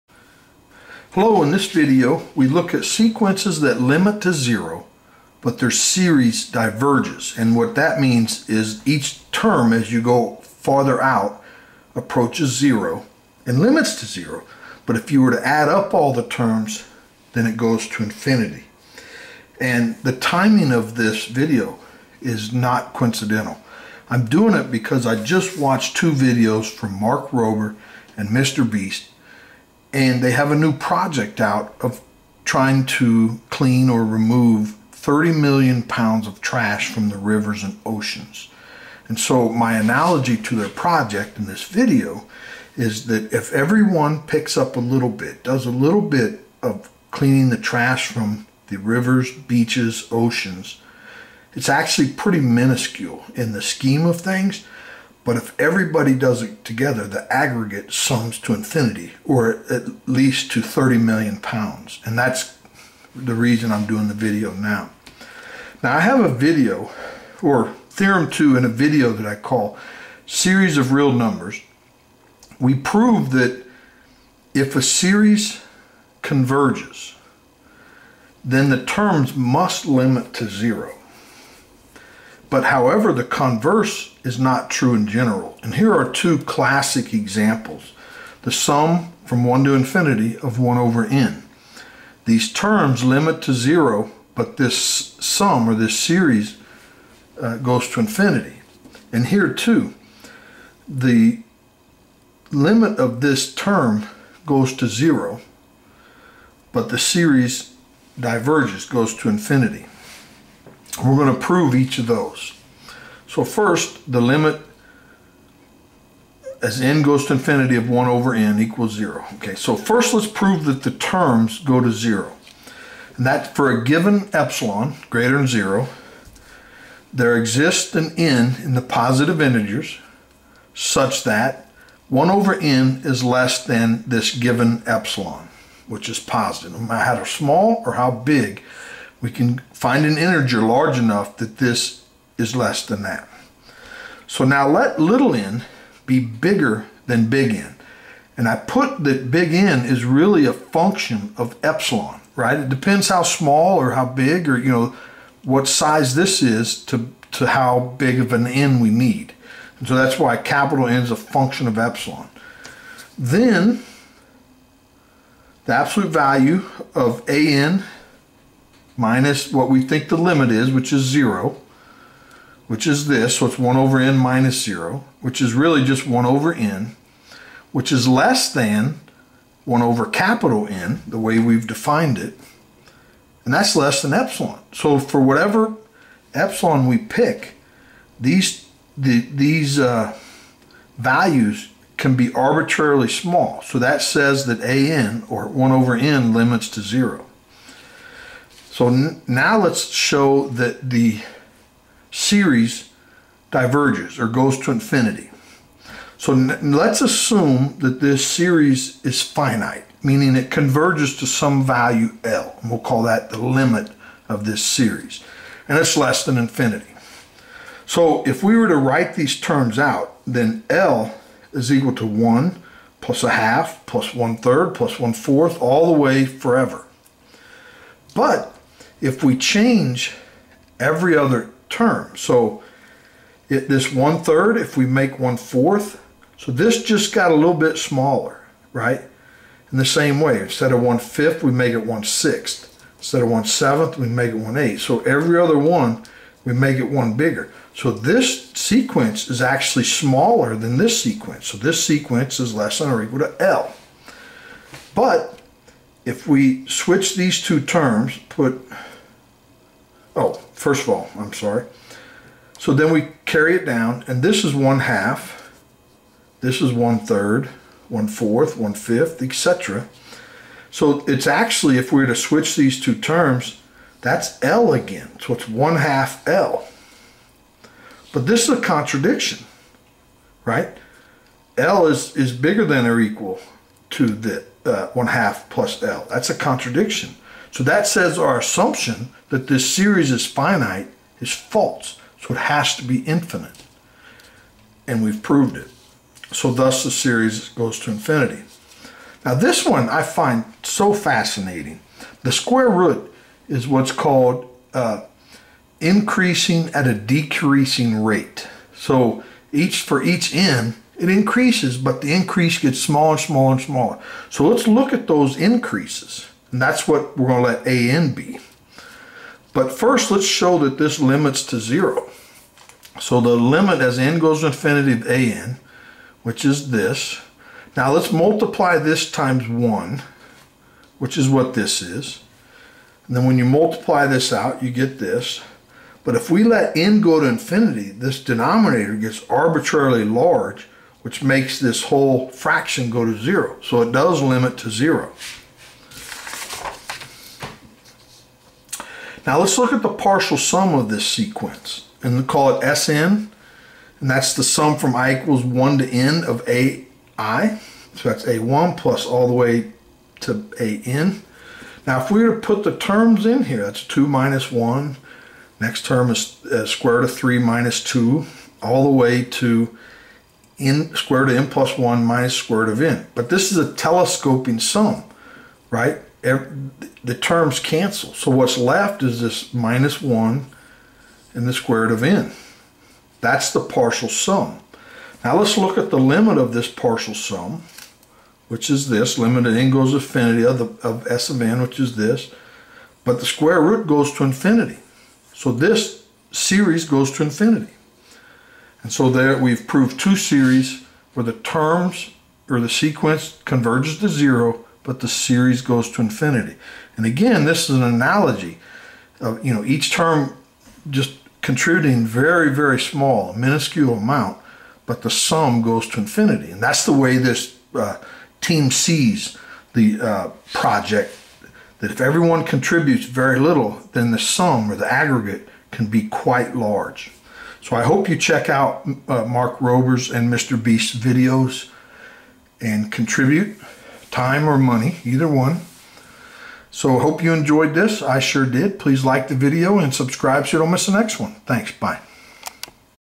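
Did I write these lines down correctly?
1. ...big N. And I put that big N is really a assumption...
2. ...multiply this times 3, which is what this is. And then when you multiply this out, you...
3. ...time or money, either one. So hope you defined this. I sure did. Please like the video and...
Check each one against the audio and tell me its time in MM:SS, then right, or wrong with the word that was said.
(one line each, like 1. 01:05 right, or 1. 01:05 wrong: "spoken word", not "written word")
1. 02:27 wrong: "function", not "assumption"
2. 05:28 wrong: "1", not "3"
3. 07:14 wrong: "enjoyed", not "defined".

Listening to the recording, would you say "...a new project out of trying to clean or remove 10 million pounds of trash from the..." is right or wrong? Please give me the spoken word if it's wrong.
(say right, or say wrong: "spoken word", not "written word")
wrong: "30", not "10".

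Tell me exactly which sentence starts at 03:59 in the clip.
In the same way, instead of one fifth, we make it one sixth.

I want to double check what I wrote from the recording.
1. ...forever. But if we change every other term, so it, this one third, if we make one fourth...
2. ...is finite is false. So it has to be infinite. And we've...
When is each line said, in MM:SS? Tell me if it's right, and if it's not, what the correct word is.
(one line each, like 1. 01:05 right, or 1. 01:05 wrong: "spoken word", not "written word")
1. 03:46 right
2. 04:50 right.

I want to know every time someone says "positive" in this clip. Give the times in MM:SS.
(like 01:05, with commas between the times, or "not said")
02:08, 02:16.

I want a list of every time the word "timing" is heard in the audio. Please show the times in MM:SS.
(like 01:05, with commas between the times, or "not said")
00:20.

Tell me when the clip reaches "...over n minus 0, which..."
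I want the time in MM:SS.
02:53.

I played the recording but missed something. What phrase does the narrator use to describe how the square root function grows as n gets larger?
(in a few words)
increasing at a decreasing rate.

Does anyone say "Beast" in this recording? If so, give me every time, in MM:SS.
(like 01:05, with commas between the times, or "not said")
00:28, 07:10.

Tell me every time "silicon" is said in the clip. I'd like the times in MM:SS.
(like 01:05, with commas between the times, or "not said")
not said.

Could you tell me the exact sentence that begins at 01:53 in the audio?
So first, the limit as n goes to infinity of 1 over n equals 0.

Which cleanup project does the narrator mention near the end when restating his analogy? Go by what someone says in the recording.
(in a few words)
Team Seas.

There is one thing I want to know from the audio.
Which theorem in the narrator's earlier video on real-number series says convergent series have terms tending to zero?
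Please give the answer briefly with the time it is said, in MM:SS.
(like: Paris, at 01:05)
Theorem 2, at 01:07.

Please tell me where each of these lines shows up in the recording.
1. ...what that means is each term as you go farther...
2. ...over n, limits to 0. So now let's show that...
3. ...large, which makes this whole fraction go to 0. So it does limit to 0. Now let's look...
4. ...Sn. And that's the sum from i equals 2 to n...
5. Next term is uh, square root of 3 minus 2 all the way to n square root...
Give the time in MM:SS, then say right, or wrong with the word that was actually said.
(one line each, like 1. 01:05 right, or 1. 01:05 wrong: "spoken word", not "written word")
1. 00:07 right
2. 03:15 right
3. 05:40 right
4. 05:52 wrong: "1", not "2"
5. 06:05 right.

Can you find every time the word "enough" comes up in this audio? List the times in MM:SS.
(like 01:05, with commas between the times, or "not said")
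02:20.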